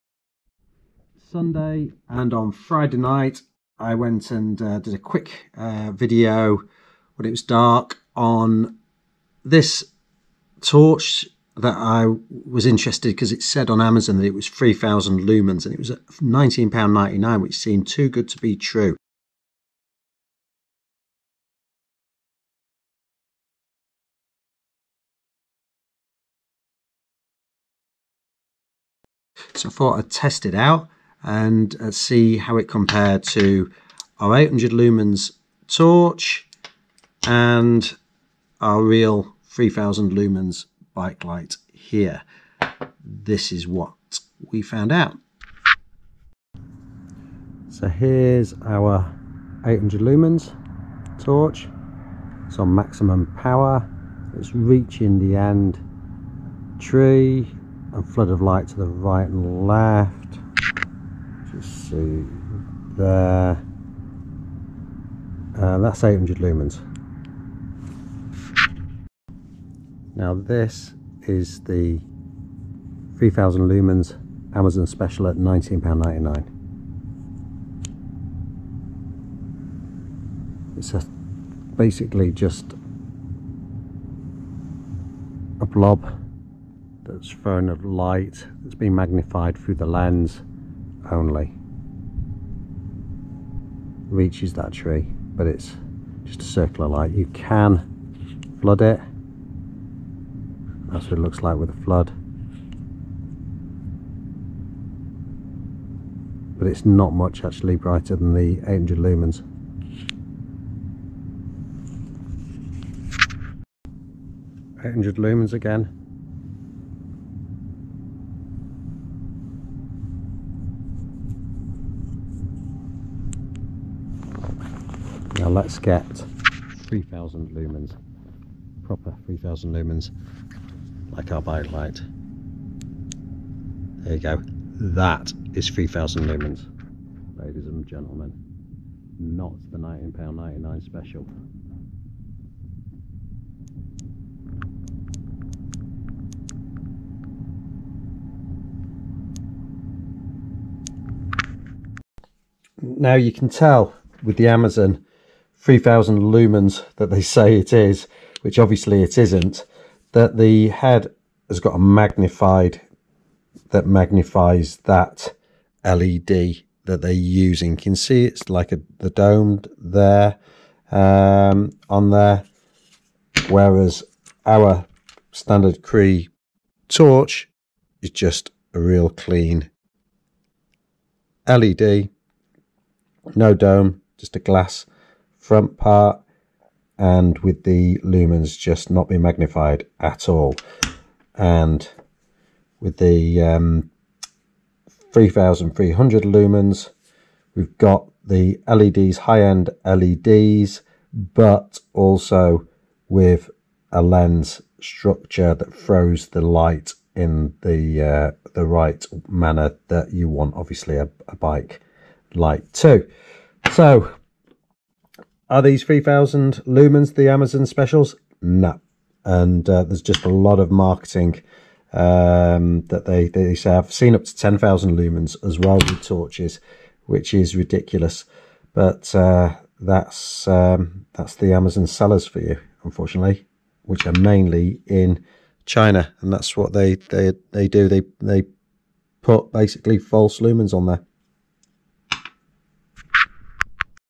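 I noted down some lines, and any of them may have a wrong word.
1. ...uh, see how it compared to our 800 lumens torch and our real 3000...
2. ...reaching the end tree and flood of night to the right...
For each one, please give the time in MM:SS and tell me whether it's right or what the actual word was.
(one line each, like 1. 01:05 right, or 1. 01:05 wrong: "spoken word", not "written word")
1. 00:31 right
2. 00:54 wrong: "light", not "night".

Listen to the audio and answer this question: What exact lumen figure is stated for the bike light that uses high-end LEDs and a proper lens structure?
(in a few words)
3300 lumens.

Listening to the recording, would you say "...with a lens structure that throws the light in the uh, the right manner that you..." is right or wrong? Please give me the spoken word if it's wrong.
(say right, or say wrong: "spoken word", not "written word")
right.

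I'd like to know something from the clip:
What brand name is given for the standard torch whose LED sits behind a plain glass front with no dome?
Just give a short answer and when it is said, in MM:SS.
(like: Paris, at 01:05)
Cree, at 02:55.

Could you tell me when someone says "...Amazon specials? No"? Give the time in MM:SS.
03:37.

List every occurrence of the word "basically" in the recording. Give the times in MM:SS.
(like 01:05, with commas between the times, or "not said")
01:21, 03:59.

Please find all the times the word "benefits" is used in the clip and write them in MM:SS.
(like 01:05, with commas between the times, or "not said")
not said.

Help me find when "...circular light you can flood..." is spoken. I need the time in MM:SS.
01:36.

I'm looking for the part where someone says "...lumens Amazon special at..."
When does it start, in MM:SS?
01:13.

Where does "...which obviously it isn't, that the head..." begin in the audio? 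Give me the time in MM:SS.
02:38.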